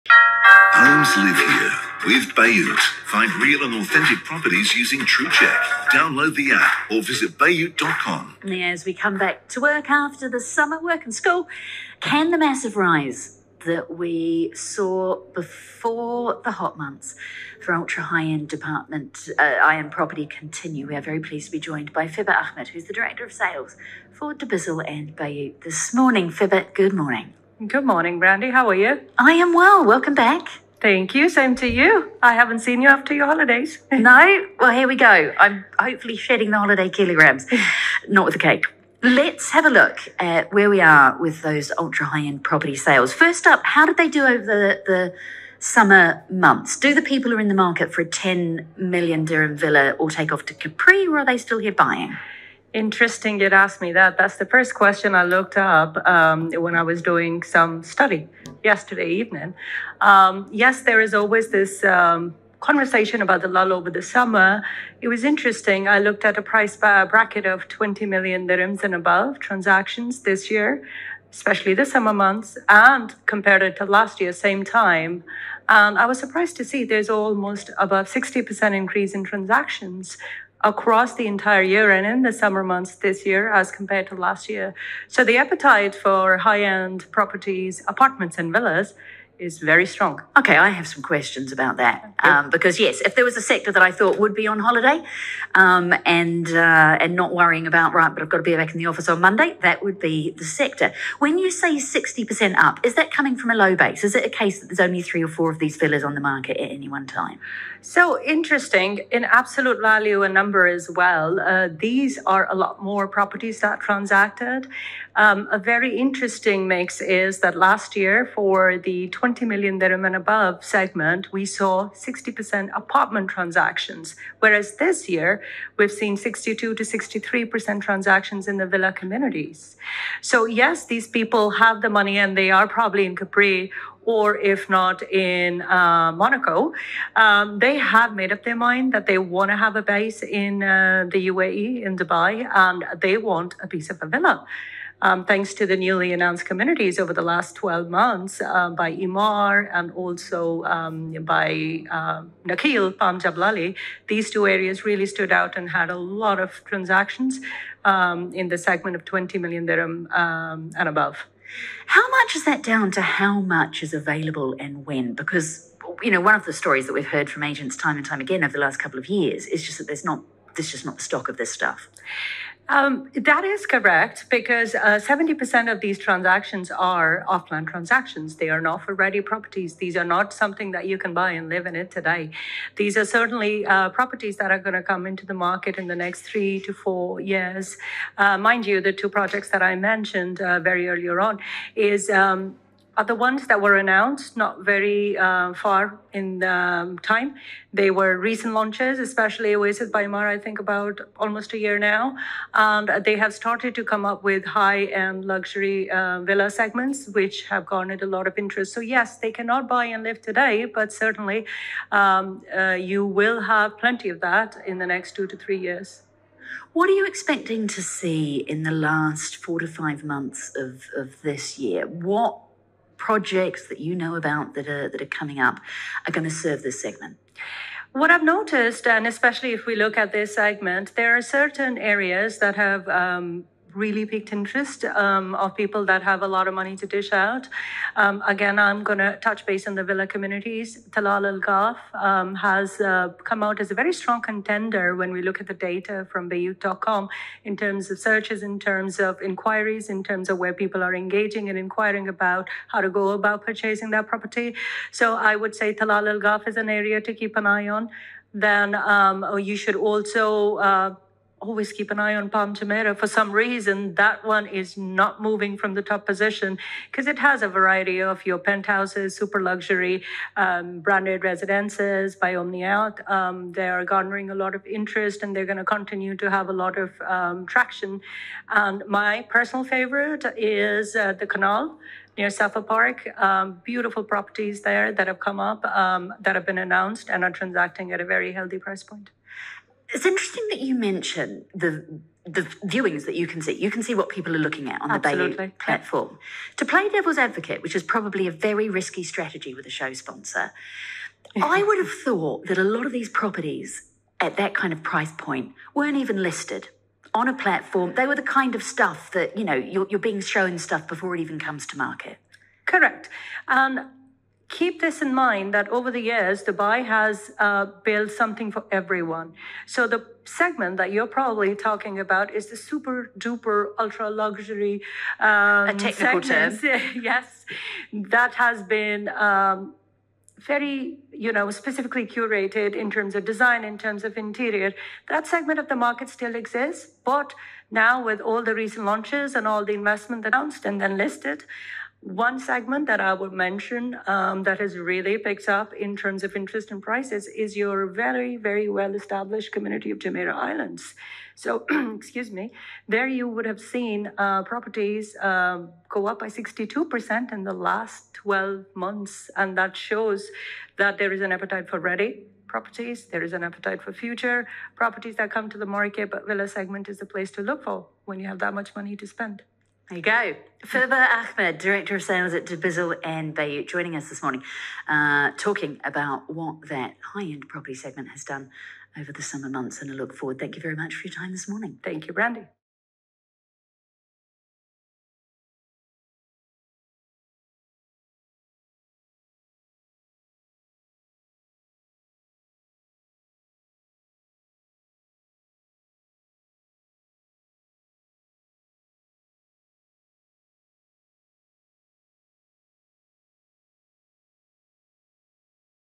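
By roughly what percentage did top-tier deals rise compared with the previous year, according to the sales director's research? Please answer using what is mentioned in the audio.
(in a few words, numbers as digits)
60%.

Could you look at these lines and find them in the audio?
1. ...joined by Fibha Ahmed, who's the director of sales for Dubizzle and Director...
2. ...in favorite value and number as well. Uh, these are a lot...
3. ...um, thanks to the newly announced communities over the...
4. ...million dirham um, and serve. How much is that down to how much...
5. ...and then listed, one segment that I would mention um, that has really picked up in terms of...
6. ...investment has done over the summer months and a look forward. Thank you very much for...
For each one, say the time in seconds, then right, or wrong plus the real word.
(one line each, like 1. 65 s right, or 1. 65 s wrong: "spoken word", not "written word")
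1. 21 s wrong: "Bayut", not "Director"
2. 109 s wrong: "absolute", not "favorite"
3. 145 s right
4. 159 s wrong: "above", not "serve"
5. 340 s right
6. 377 s wrong: "segment", not "investment".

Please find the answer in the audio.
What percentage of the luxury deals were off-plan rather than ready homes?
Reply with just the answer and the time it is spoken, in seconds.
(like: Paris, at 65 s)
70%, at 175 s.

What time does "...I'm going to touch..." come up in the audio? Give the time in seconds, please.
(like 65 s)
238 s.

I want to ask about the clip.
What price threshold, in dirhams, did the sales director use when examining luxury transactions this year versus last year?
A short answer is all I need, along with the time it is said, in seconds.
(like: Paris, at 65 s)
20 million dirhams, at 67 s.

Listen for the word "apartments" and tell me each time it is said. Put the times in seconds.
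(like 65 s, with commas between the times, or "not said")
87 s, 122 s.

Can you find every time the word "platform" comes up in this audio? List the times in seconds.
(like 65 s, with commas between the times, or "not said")
295 s, 307 s.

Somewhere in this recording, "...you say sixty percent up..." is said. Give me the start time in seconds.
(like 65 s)
101 s.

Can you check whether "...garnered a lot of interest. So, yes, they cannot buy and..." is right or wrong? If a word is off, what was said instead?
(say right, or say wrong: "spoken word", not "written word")
right.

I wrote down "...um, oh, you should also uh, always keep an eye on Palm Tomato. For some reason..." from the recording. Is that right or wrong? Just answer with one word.
right.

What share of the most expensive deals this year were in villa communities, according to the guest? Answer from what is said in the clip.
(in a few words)
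62 to 63%.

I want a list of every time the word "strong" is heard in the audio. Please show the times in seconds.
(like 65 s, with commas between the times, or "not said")
89 s, 243 s.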